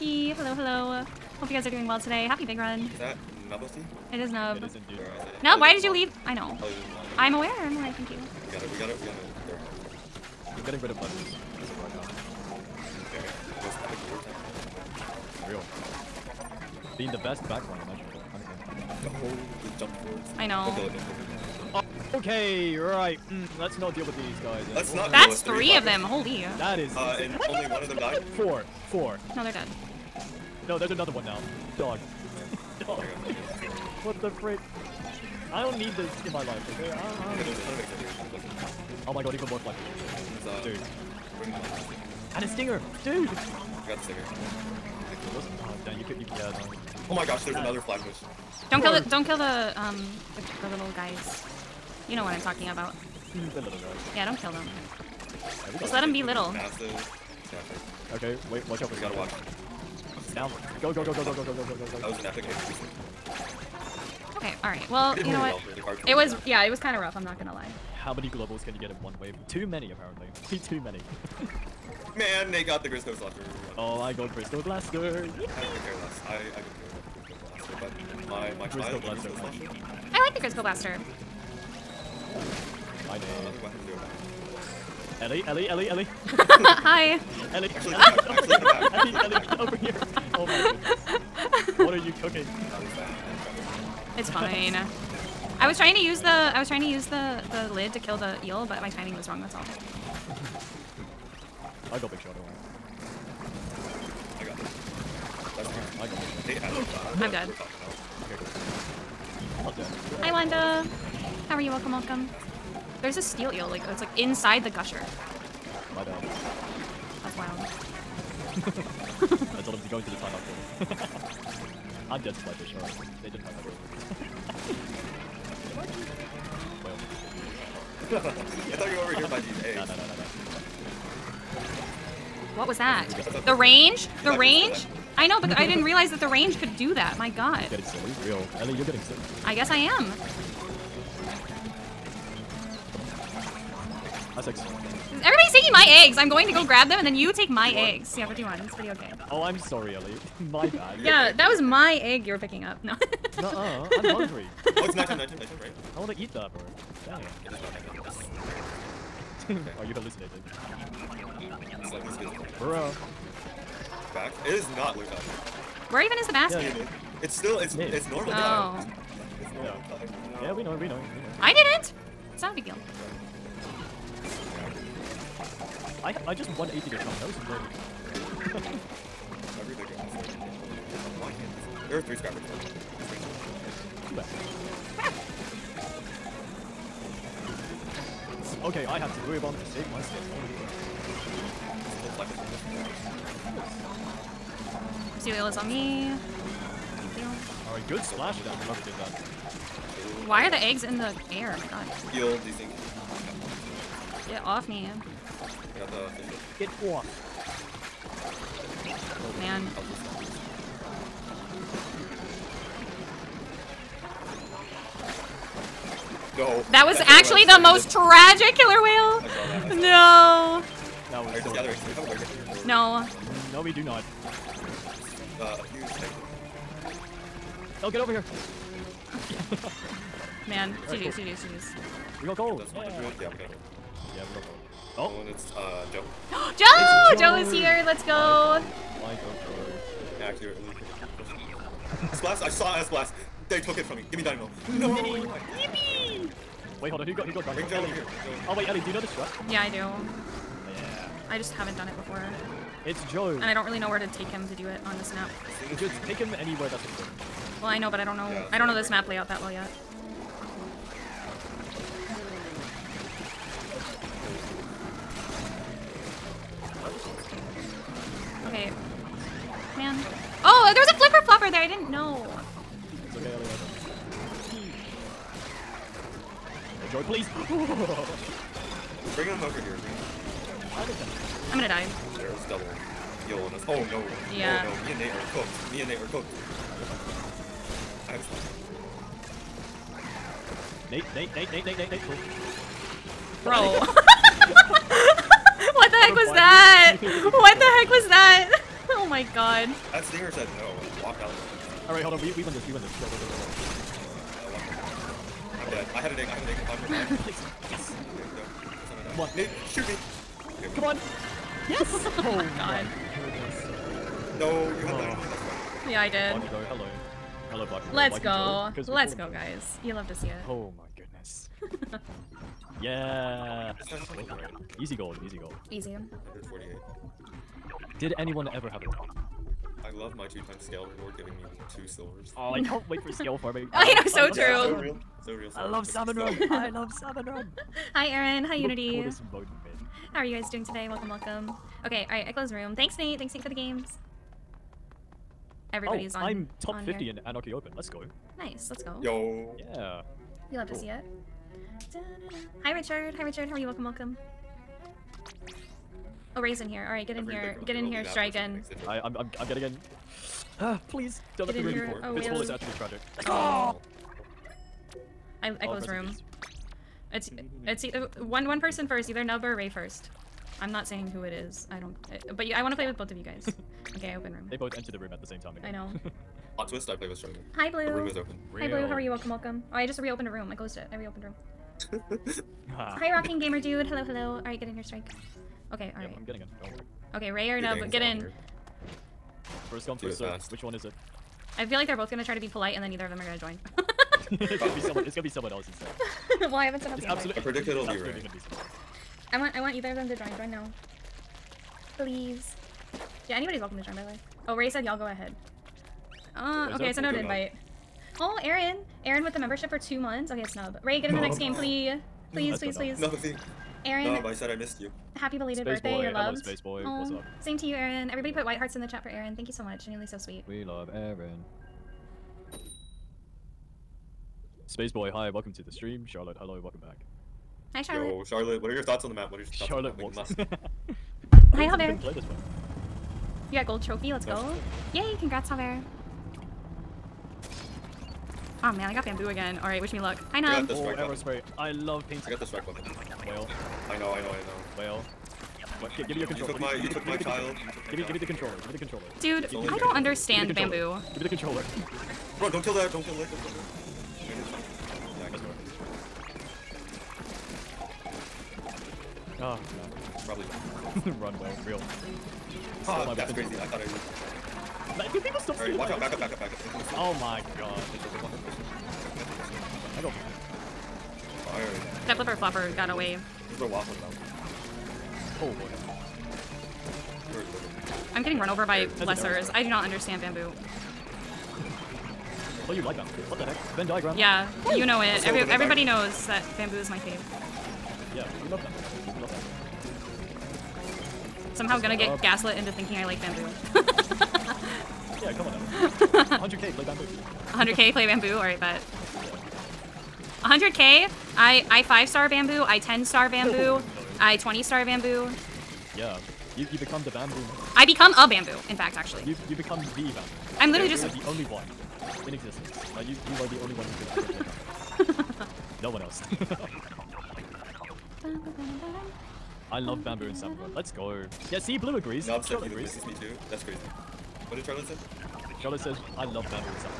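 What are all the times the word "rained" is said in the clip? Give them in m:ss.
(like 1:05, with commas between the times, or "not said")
not said.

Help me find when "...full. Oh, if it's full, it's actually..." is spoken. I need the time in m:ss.
6:01.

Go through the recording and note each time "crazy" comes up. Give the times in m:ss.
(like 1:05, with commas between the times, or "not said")
7:43, 8:43.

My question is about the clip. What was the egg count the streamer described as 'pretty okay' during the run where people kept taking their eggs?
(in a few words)
51.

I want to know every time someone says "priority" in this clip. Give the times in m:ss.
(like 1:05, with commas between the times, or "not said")
not said.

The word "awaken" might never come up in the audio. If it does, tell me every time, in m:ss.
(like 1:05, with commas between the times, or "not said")
not said.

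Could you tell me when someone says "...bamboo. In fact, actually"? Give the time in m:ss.
8:28.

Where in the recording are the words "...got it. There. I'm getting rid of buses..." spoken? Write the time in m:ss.
0:09.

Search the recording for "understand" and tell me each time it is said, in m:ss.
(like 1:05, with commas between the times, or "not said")
7:29, 7:59.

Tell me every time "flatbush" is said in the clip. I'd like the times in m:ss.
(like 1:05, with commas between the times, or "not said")
0:47.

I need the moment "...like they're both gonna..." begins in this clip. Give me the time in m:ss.
6:31.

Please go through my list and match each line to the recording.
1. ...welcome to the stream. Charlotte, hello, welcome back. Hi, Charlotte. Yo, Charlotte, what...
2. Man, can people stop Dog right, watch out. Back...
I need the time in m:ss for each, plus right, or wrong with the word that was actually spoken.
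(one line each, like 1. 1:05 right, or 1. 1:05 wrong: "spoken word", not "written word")
1. 7:05 right
2. 7:44 wrong: "All", not "Dog".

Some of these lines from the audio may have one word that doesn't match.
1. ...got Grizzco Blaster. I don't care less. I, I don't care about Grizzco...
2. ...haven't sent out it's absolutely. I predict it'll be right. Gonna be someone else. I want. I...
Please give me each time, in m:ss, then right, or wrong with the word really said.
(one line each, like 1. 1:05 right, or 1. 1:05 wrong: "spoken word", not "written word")
1. 1:14 right
2. 6:36 right.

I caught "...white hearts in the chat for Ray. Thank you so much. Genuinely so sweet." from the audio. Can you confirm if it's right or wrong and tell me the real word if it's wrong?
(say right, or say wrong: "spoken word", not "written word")
wrong: "Aaron", not "Ray".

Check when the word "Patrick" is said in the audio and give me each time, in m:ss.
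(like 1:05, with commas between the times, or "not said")
not said.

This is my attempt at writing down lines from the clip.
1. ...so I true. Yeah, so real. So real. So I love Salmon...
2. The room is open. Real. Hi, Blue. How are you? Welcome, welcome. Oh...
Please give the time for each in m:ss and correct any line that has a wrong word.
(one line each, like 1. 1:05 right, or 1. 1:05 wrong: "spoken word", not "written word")
1. 5:34 right
2. 6:17 right.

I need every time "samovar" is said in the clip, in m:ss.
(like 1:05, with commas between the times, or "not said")
8:40.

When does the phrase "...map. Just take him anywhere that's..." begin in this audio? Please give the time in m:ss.
4:15.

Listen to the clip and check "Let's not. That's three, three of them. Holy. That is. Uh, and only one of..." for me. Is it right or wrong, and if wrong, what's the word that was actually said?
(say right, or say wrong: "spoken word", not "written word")
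right.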